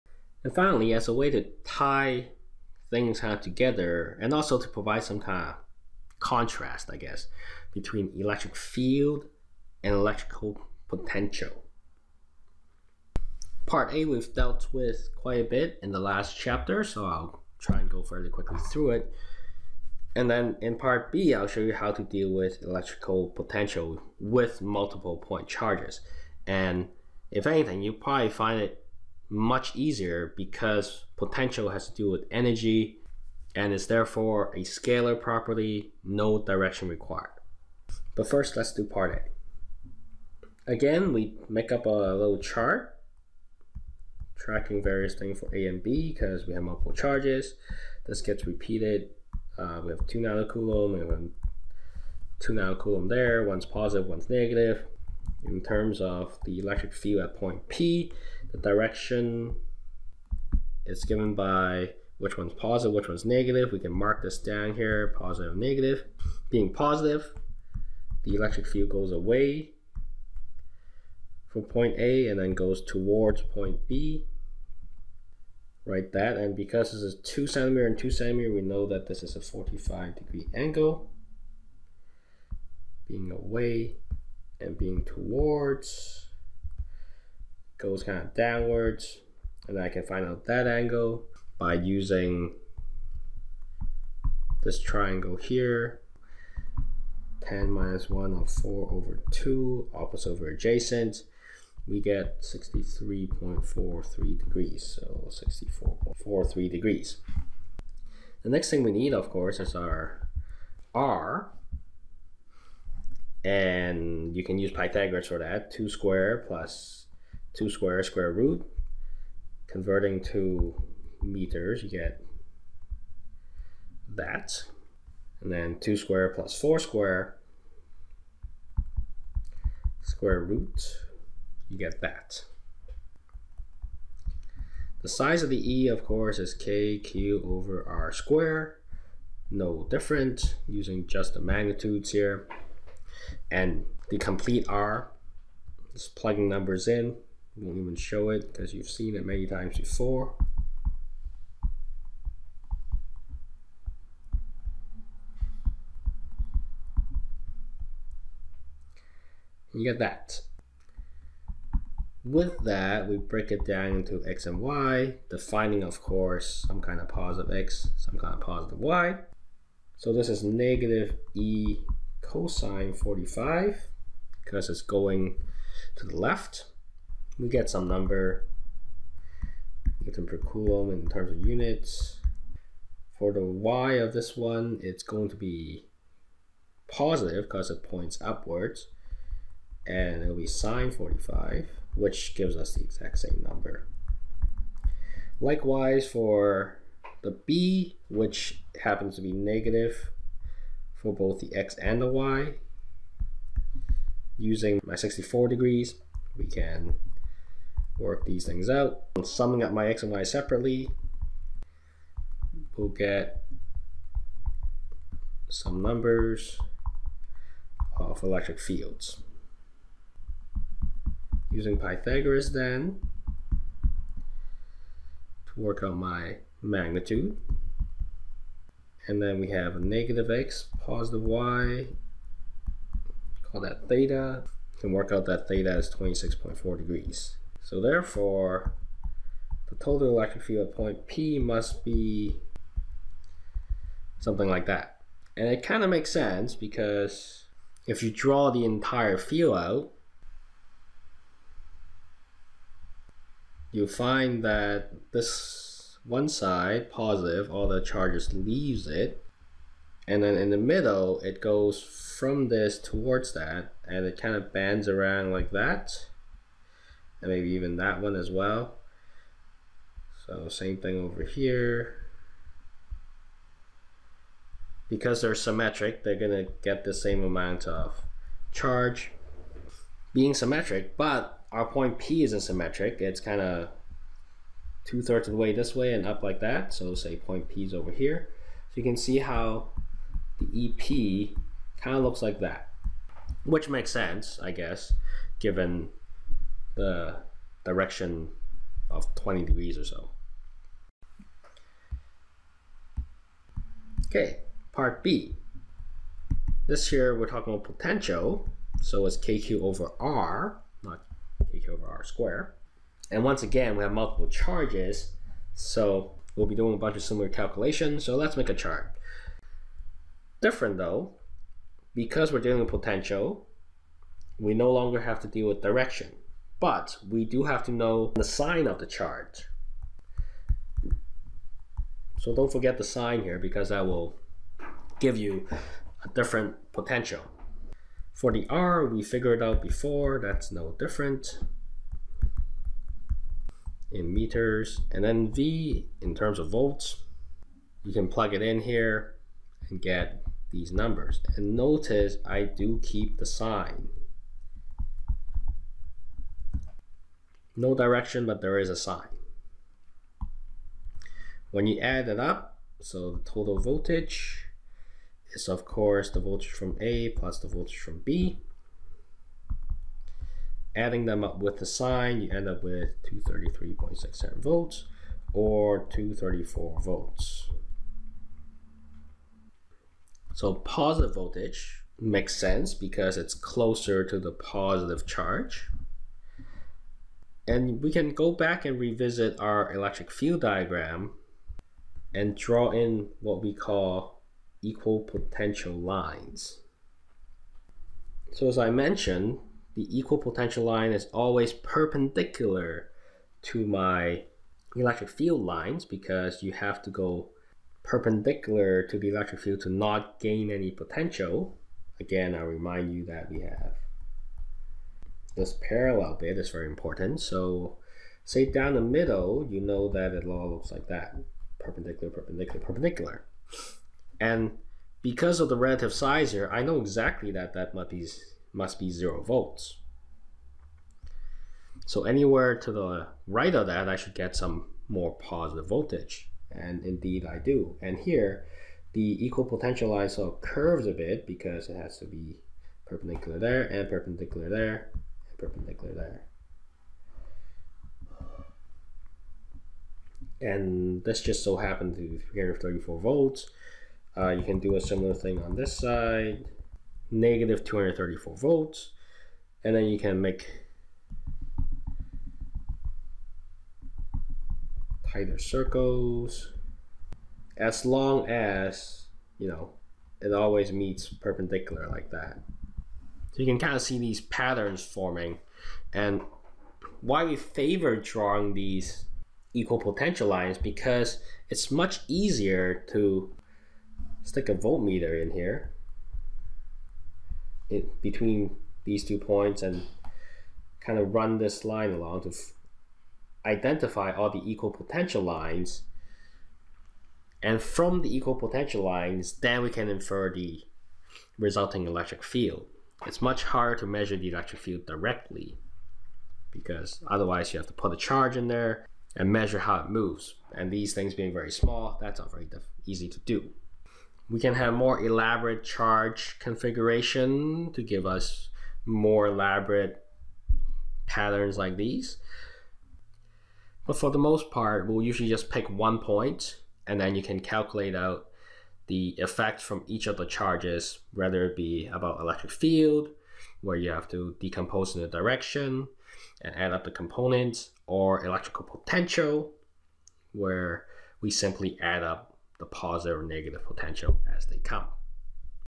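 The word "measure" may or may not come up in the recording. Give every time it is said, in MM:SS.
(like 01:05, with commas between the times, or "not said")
08:23, 08:29.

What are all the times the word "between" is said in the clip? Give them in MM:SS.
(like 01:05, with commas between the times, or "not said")
00:07, 08:08.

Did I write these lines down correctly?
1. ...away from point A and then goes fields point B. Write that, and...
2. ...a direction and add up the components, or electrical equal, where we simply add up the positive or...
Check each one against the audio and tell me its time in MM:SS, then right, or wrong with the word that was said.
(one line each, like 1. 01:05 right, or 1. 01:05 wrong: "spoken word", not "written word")
1. 01:09 wrong: "towards", not "fields"
2. 08:55 wrong: "potential", not "equal".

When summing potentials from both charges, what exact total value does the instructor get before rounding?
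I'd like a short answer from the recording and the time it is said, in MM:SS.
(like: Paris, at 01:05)
233.67 volts, at 06:13.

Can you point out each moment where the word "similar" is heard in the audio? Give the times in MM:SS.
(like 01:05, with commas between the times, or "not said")
05:17, 07:34.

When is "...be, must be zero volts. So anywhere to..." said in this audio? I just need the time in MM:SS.
07:07.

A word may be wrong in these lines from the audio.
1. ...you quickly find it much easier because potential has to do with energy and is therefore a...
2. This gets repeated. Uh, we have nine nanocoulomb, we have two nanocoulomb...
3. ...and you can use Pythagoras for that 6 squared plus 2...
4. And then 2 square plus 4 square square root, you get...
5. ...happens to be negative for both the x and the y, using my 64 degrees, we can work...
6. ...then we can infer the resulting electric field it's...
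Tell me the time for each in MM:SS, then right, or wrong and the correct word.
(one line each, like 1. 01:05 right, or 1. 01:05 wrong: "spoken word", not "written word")
1. 00:27 wrong: "probably", not "quickly"
2. 00:48 wrong: "two", not "nine"
3. 01:53 wrong: "2", not "6"
4. 02:05 right
5. 03:18 right
6. 08:19 right.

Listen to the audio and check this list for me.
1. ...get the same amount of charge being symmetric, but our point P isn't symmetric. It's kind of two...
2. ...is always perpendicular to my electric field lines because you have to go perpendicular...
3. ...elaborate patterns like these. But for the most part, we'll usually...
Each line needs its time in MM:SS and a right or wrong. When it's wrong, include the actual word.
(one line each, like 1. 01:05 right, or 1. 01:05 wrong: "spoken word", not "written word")
1. 04:36 right
2. 06:40 right
3. 08:39 right.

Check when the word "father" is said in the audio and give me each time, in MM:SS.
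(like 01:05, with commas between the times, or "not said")
not said.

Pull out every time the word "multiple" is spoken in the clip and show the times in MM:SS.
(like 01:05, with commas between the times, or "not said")
00:24, 00:46, 05:13.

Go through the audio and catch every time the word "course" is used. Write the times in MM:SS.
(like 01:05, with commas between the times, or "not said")
01:49, 02:16, 02:46, 06:05.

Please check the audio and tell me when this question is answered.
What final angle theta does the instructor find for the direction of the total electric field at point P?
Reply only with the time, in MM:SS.
03:55.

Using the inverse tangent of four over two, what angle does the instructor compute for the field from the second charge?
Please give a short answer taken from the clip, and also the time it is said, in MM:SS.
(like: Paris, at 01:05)
63.43 degrees, at 01:42.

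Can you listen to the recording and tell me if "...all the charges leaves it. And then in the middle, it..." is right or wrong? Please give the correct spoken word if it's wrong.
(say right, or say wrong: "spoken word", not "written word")
right.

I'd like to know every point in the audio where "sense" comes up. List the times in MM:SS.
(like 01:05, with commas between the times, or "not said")
04:06, 04:53, 06:22.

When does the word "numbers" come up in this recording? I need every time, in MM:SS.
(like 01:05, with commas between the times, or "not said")
02:26, 02:57, 03:13, 03:35, 05:50.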